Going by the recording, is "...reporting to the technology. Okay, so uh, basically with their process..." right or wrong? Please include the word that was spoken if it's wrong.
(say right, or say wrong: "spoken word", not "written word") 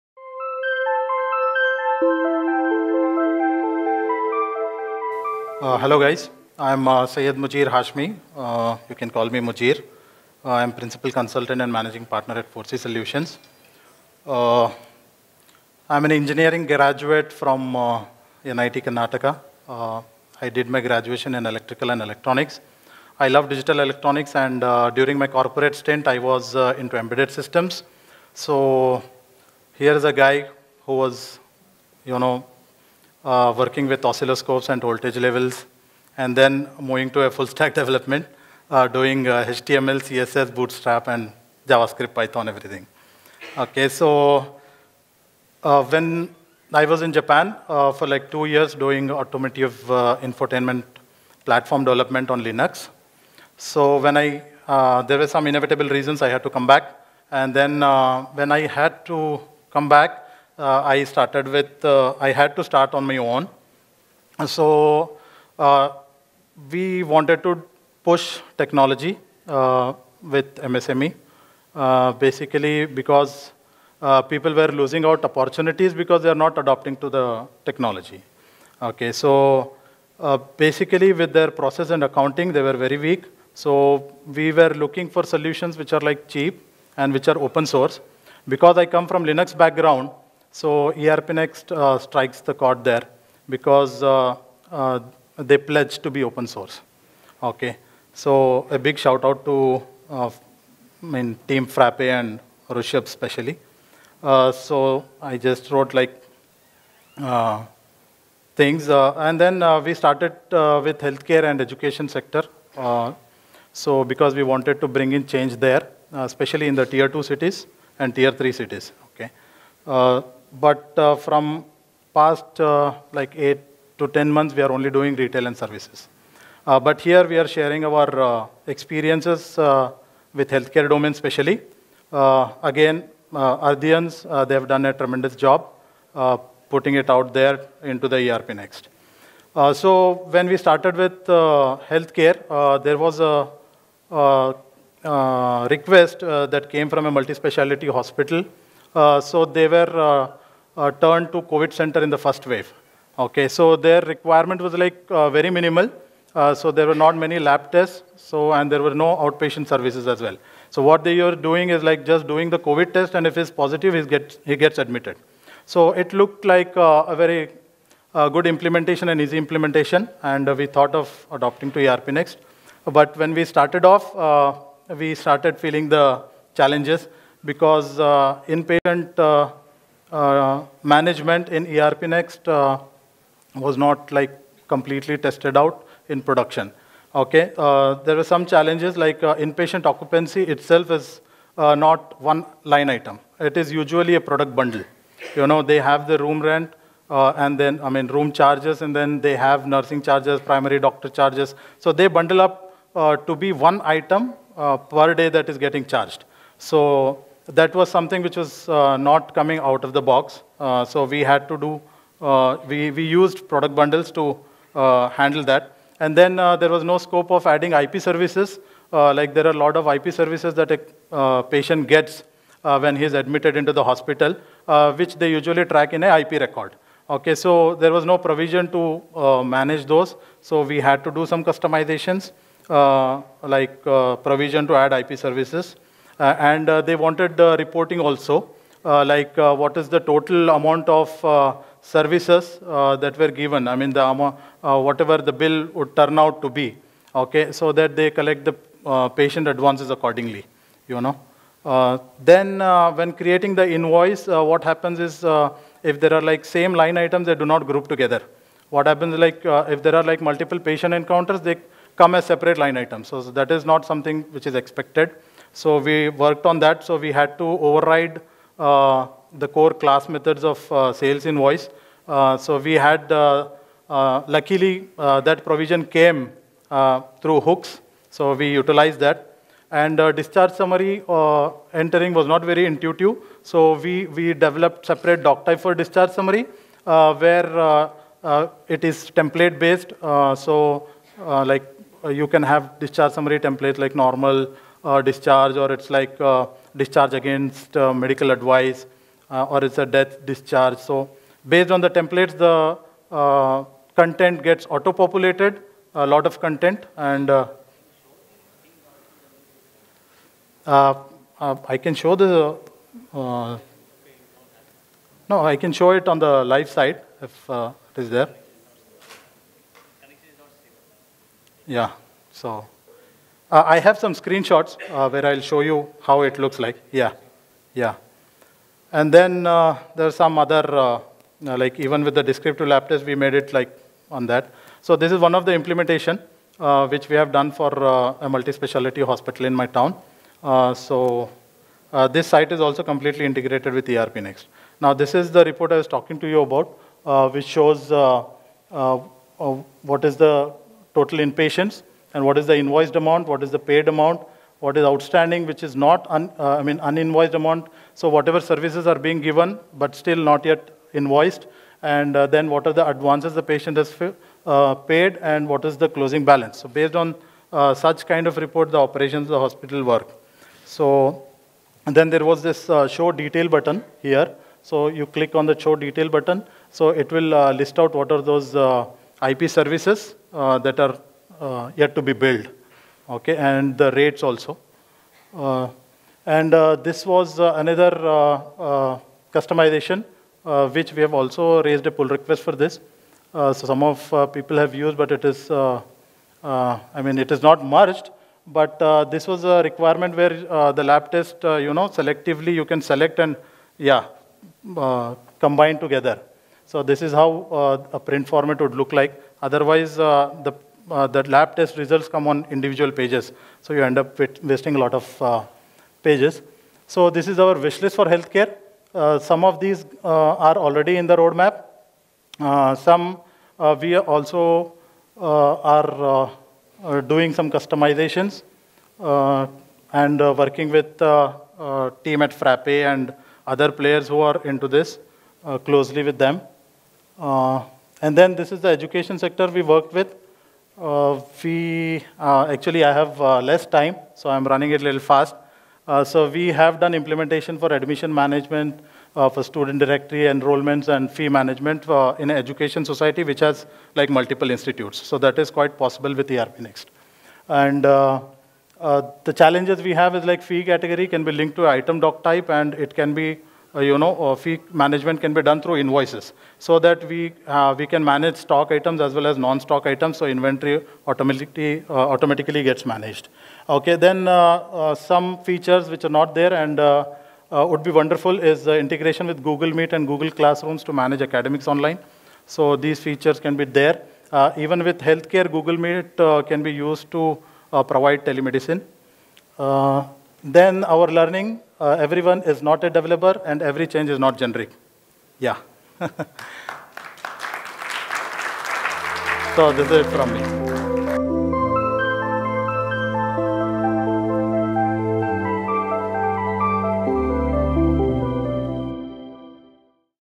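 wrong: "adopting", not "reporting".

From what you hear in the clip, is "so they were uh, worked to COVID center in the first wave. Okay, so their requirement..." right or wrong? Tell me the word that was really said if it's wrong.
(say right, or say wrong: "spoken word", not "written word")
wrong: "turned", not "worked".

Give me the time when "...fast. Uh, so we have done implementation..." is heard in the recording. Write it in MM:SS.
07:25.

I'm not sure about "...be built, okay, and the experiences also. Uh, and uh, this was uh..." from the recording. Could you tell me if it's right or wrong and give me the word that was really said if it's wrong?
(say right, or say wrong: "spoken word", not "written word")
wrong: "rates", not "experiences".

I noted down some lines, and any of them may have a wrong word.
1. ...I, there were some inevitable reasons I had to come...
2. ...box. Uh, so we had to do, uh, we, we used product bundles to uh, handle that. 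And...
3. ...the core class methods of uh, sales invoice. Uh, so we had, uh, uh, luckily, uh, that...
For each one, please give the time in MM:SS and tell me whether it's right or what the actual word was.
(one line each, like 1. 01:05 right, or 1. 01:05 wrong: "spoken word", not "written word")
1. 00:54 right
2. 03:30 right
3. 04:29 right.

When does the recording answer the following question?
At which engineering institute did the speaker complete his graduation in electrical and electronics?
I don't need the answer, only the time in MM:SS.
00:18.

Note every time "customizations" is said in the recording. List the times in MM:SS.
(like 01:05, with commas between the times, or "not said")
03:51, 06:29, 07:07.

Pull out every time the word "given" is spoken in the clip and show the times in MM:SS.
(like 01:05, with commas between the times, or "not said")
04:03, 05:59.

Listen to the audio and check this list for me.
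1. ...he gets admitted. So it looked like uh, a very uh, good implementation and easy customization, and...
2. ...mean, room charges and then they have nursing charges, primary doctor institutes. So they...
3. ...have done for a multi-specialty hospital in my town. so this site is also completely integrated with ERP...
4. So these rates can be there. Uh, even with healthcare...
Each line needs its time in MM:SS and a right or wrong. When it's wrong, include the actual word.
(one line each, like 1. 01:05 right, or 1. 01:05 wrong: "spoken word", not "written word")
1. 02:44 wrong: "implementation", not "customization"
2. 03:17 wrong: "charges", not "institutes"
3. 05:37 right
4. 08:02 wrong: "features", not "rates".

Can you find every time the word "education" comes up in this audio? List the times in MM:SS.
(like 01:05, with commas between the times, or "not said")
01:51, 07:18, 07:32.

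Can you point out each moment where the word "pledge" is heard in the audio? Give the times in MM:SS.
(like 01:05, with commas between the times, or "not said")
01:35.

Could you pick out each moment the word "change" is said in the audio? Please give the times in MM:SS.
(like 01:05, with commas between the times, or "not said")
01:55, 08:13.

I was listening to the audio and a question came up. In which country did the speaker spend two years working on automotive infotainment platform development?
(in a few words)
Japan.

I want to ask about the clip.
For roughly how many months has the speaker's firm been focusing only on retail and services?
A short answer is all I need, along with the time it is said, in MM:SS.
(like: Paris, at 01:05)
8 to 10 months, at 02:03.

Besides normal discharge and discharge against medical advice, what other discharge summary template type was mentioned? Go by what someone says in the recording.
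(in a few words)
Death discharge.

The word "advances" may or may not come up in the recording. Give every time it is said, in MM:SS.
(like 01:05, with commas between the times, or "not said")
04:09, 06:02.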